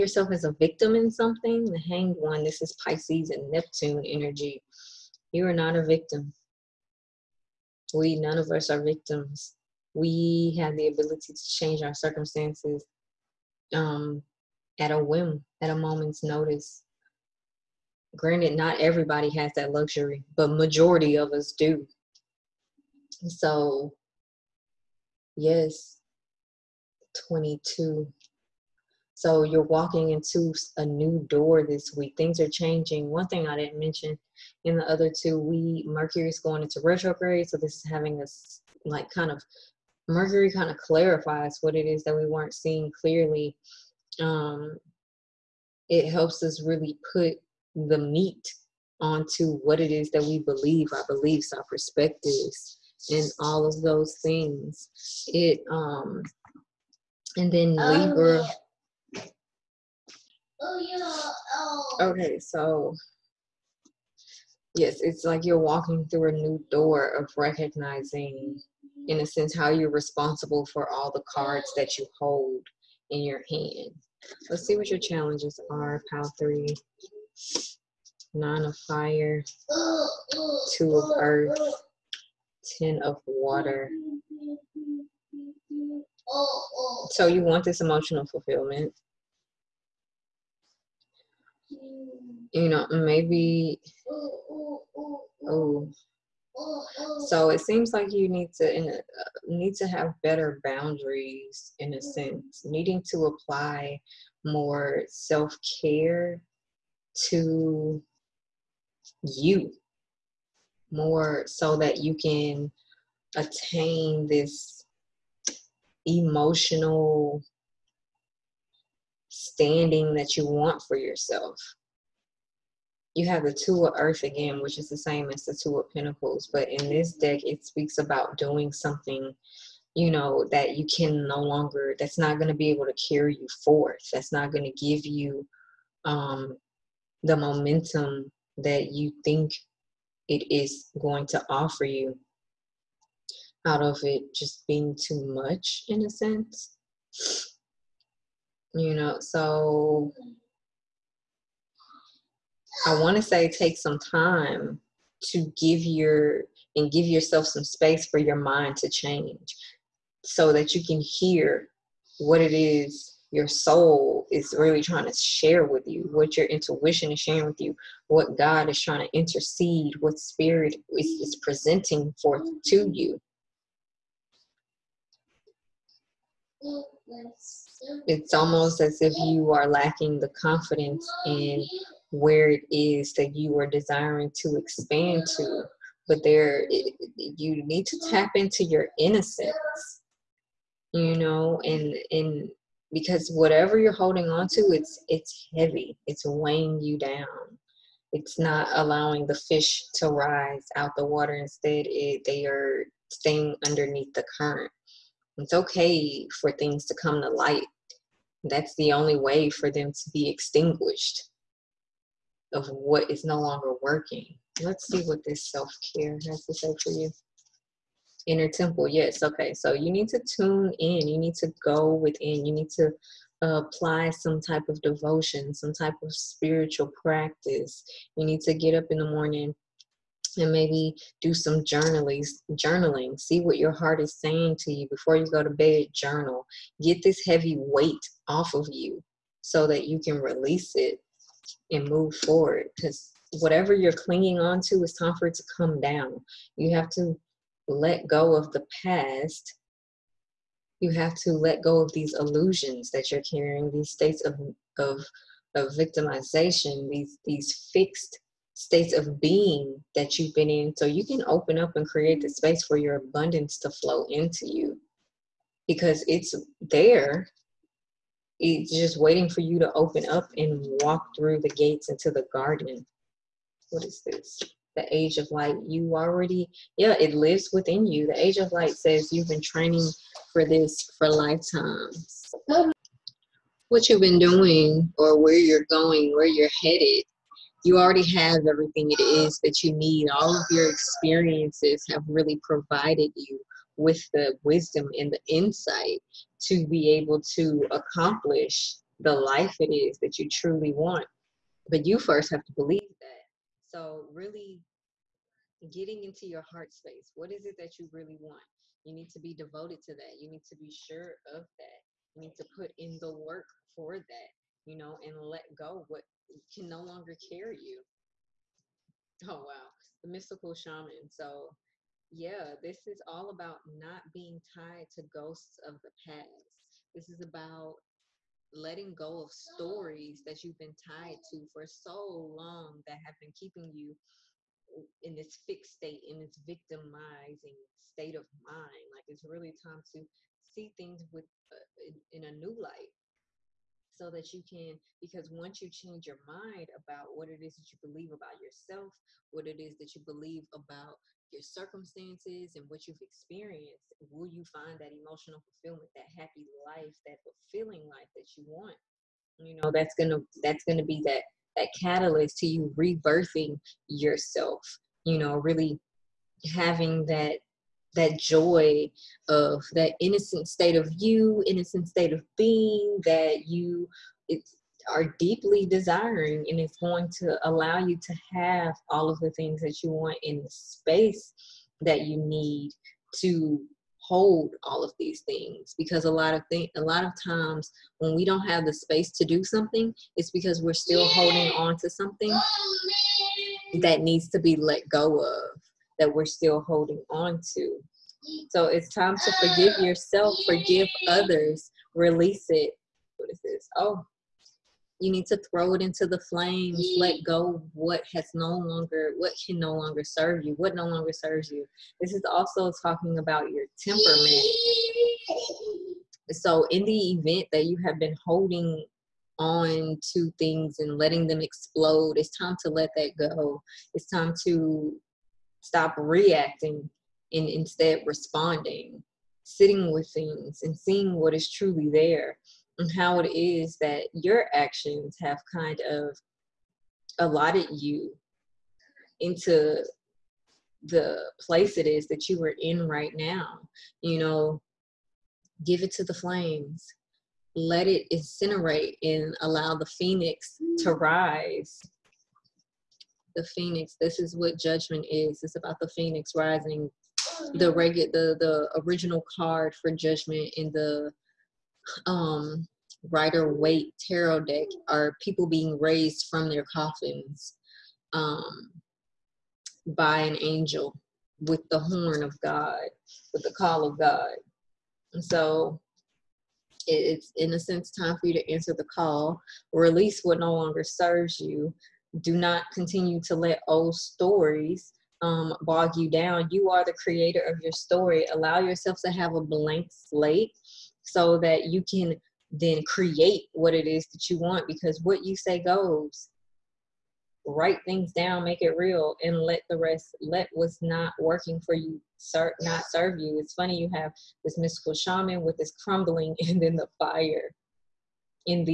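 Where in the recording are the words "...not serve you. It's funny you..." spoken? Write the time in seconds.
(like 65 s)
502 s.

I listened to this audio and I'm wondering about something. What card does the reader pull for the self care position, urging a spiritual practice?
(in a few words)
Inner temple.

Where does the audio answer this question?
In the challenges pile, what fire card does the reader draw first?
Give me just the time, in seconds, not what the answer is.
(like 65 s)
78 s.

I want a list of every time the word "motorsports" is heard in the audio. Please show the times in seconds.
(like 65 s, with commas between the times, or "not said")
not said.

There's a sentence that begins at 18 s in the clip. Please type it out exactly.
Granted, not everybody has that luxury, but majority of us do.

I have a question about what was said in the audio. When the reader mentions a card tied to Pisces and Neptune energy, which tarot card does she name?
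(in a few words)
The Hanged One.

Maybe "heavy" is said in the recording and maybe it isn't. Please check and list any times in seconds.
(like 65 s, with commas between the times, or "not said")
195 s, 237 s.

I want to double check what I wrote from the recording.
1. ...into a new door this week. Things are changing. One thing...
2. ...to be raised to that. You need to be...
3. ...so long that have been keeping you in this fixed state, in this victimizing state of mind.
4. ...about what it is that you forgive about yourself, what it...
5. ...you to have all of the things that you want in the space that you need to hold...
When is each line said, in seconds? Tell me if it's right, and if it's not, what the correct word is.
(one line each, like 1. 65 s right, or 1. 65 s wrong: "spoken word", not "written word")
1. 30 s right
2. 309 s wrong: "devoted", not "raised"
3. 331 s right
4. 346 s wrong: "believe", not "forgive"
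5. 377 s right.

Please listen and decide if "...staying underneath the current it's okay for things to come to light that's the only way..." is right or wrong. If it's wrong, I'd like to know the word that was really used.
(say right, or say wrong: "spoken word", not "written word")
right.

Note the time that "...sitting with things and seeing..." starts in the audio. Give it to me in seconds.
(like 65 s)
429 s.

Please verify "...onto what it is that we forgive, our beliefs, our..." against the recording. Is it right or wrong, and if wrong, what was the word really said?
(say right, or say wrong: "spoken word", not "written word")
wrong: "believe", not "forgive".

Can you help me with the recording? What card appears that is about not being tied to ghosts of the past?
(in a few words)
The mystical shaman.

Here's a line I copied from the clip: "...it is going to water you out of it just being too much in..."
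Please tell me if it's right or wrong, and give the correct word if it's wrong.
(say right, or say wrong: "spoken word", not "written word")
wrong: "offer", not "water".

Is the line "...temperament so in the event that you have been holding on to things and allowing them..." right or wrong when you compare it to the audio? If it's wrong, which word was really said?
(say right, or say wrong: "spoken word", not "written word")
wrong: "letting", not "allowing".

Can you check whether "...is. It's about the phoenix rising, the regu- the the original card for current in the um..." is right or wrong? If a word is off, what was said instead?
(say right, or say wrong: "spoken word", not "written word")
wrong: "judgment", not "current".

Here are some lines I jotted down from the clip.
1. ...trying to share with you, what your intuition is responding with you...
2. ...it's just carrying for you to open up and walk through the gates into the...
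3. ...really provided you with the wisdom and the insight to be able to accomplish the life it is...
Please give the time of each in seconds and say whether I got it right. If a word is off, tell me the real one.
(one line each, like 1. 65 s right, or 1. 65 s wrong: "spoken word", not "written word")
1. 164 s wrong: "sharing", not "responding"
2. 268 s wrong: "waiting", not "carrying"
3. 292 s right.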